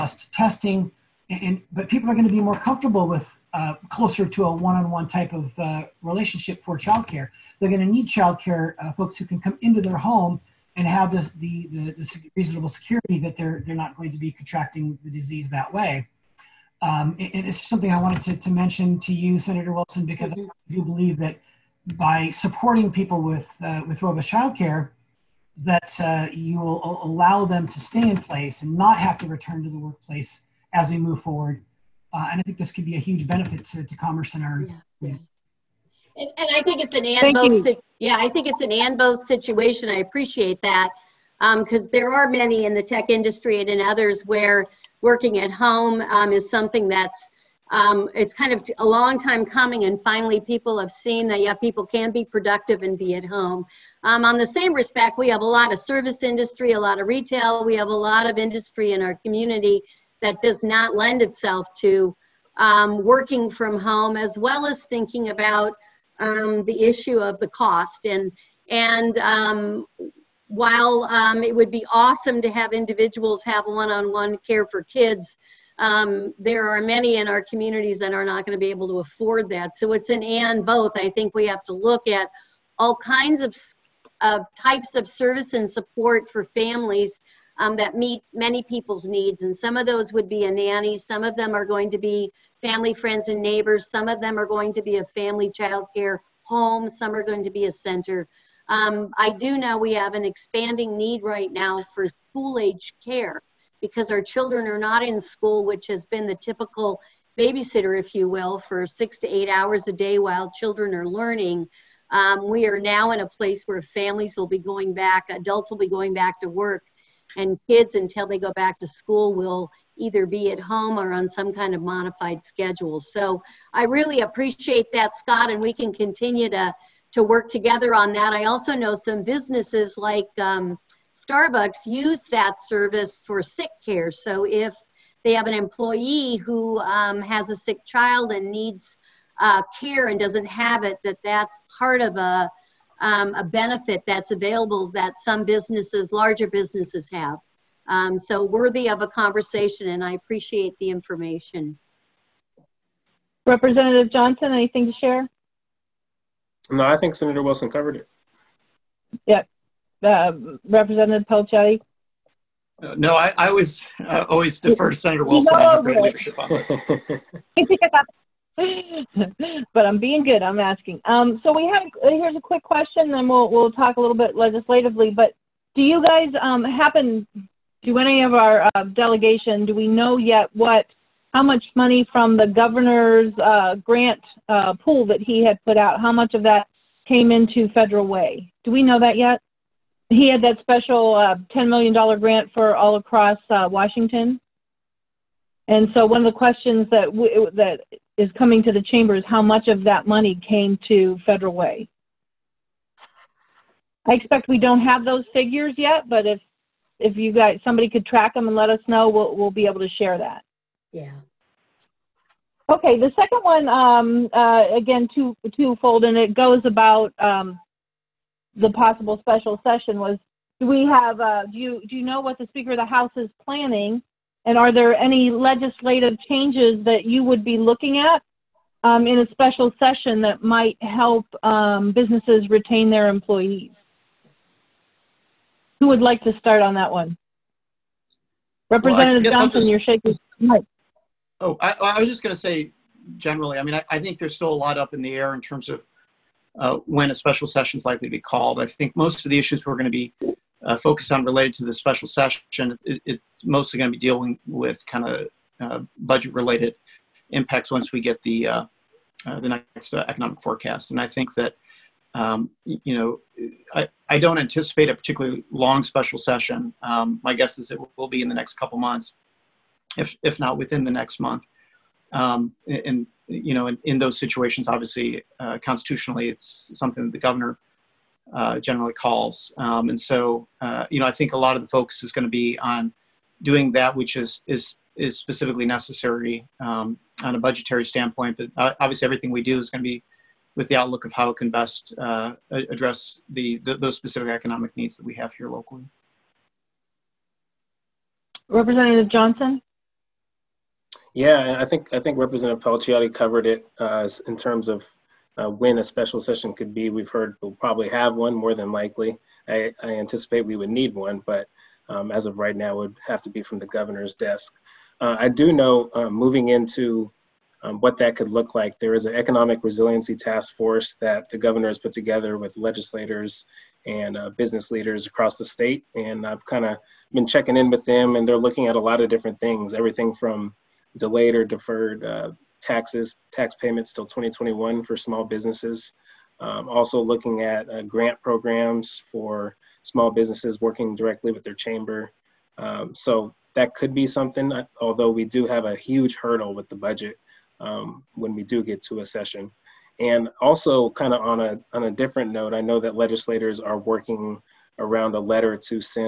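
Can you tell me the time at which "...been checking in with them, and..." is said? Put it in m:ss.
5:27.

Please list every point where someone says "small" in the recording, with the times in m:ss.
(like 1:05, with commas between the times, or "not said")
5:34, 5:39.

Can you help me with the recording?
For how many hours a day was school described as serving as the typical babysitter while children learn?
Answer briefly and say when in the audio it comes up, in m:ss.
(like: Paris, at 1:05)
6 to 8 hours, at 1:48.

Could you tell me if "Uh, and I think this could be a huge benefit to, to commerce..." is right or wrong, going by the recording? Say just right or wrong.
right.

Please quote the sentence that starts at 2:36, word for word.
No, I think Senator Wilson covered it.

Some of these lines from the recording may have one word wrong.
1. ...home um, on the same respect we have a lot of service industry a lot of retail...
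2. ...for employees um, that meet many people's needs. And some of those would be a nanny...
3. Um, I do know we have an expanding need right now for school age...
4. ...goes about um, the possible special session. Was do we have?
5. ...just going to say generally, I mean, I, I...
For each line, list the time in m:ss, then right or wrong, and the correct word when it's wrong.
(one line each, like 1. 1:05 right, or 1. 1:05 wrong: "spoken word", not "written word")
1. 0:53 right
2. 1:26 wrong: "families", not "employees"
3. 1:38 right
4. 3:36 right
5. 4:02 right.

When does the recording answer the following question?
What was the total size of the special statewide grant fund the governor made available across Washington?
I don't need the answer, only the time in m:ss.
3:11.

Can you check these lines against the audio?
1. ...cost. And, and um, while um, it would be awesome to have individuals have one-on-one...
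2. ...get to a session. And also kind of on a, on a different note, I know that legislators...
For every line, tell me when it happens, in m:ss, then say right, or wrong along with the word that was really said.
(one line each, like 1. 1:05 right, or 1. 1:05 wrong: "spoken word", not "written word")
1. 1:07 right
2. 5:48 right.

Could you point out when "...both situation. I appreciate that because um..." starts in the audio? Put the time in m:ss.
0:38.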